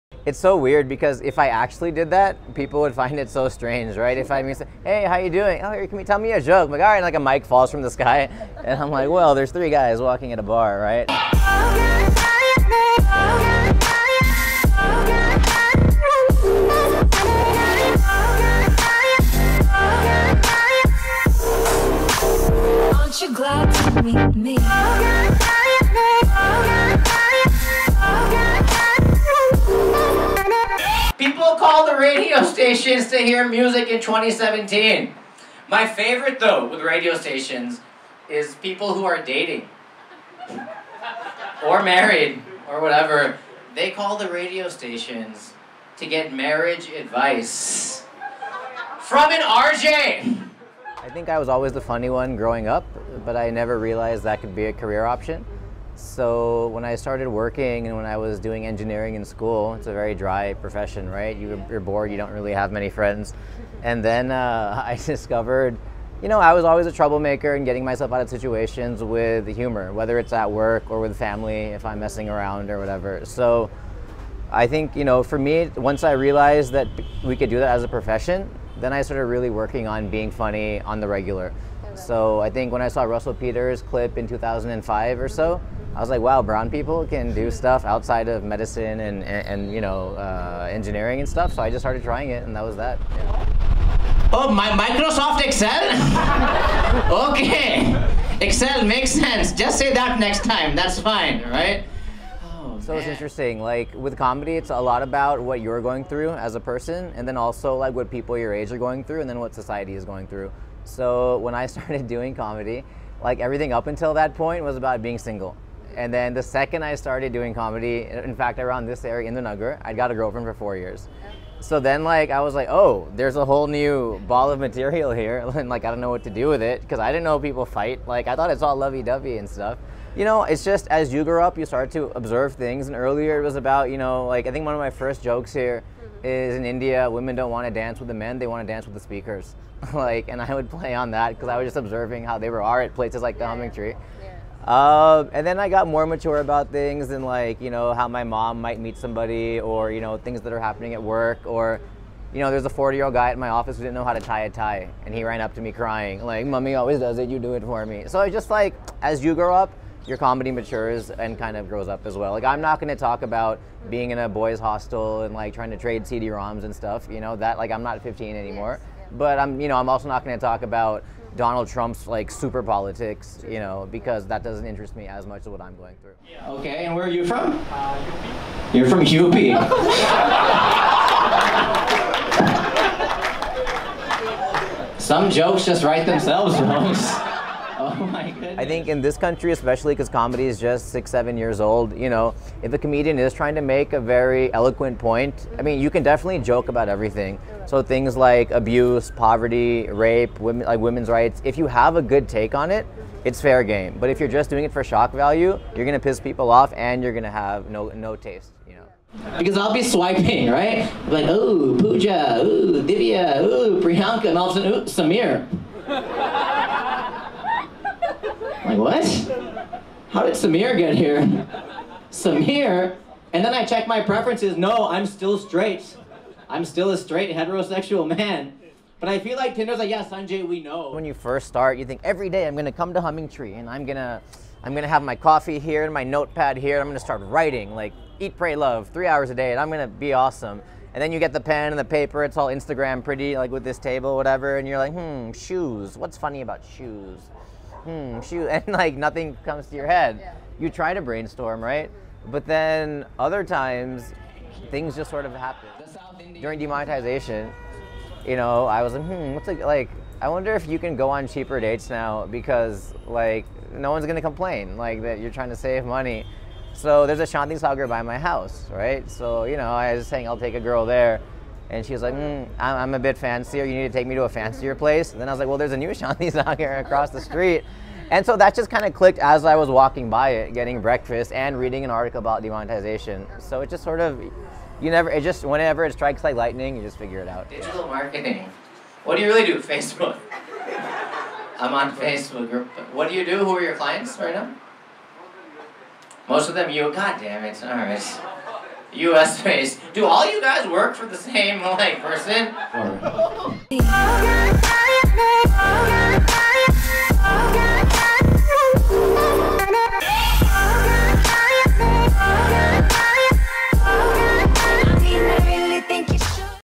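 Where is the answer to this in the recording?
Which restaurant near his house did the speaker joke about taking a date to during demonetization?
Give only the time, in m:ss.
4:27.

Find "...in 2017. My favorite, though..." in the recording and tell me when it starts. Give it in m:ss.
0:33.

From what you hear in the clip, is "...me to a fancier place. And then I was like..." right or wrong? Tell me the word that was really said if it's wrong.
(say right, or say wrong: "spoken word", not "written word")
right.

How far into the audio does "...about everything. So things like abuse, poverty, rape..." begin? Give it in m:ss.
3:16.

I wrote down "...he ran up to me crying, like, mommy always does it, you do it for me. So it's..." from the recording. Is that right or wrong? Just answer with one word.
right.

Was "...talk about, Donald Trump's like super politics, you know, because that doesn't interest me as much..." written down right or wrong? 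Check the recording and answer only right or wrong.
right.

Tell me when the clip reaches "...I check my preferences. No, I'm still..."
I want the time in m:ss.
3:43.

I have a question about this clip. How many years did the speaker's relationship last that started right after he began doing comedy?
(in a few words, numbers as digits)
4.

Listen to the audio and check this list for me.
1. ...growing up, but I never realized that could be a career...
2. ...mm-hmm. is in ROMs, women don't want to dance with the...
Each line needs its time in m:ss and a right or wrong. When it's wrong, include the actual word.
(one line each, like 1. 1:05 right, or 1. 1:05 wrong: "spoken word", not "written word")
1. 0:52 right
2. 2:16 wrong: "India", not "ROMs".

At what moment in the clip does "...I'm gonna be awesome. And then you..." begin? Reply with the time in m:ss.
3:59.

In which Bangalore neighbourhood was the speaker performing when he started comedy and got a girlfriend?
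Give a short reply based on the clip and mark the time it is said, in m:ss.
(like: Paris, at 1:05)
Indiranagar, at 1:59.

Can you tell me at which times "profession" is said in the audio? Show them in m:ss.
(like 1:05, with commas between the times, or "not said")
1:00, 1:17.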